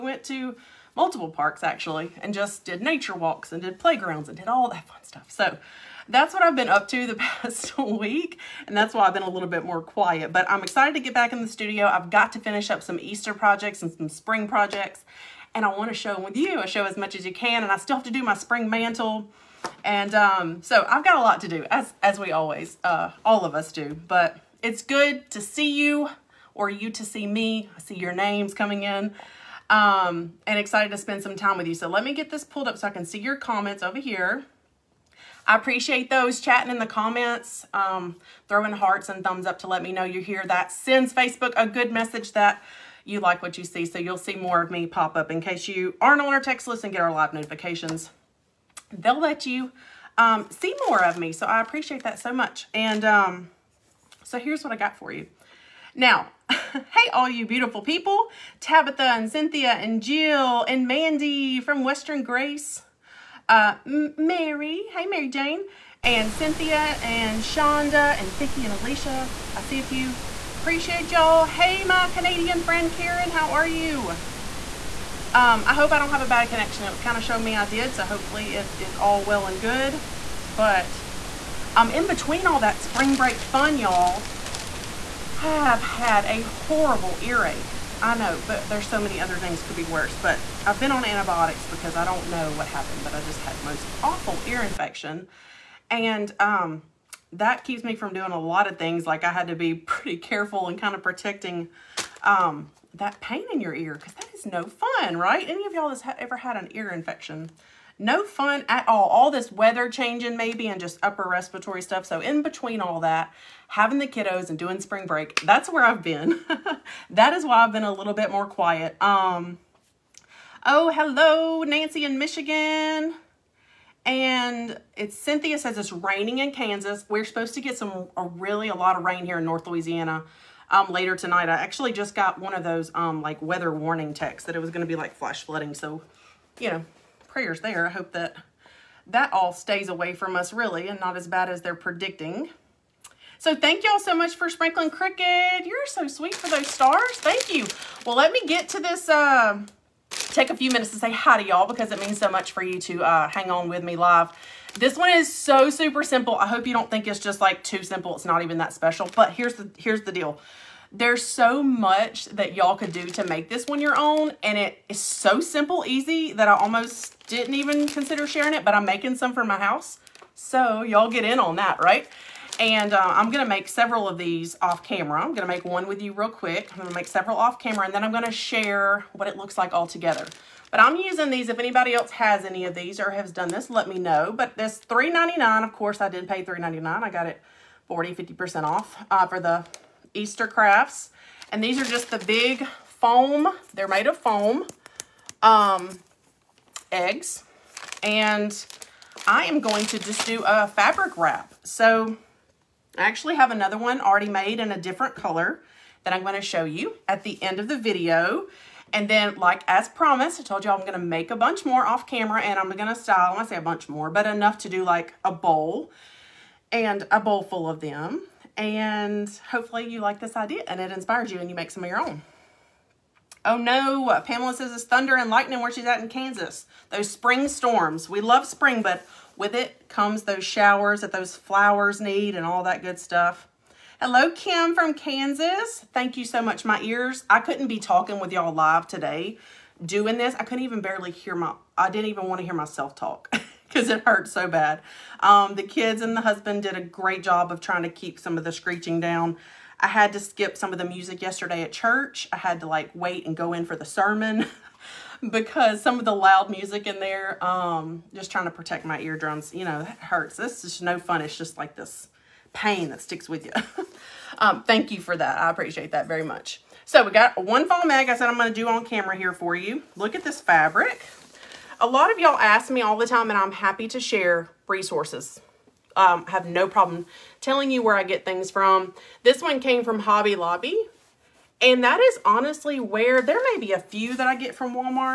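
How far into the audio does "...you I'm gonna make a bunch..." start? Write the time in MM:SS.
03:30.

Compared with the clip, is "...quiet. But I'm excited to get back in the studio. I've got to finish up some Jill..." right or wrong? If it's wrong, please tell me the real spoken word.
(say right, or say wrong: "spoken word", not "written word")
wrong: "Easter", not "Jill".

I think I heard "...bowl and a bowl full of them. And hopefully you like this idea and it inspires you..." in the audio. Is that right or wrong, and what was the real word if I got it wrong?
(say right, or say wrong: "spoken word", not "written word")
right.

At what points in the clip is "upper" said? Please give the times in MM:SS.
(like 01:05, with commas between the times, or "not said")
01:51.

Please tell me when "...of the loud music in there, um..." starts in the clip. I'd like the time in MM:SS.
04:15.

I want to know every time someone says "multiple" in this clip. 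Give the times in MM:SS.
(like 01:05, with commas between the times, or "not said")
00:00.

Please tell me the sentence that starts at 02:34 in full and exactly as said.
This one is so super simple.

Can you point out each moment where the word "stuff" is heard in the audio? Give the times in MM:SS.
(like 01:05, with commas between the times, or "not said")
00:05, 01:51, 03:52.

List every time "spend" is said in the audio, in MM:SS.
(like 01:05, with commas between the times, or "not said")
00:30.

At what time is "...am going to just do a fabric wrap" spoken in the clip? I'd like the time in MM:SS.
03:19.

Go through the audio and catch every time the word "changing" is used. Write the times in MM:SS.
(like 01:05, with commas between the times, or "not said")
01:49.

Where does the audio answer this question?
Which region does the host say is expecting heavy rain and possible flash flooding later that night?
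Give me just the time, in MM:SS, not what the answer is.
02:09.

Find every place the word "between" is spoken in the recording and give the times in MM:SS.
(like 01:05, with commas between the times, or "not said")
01:22, 01:52.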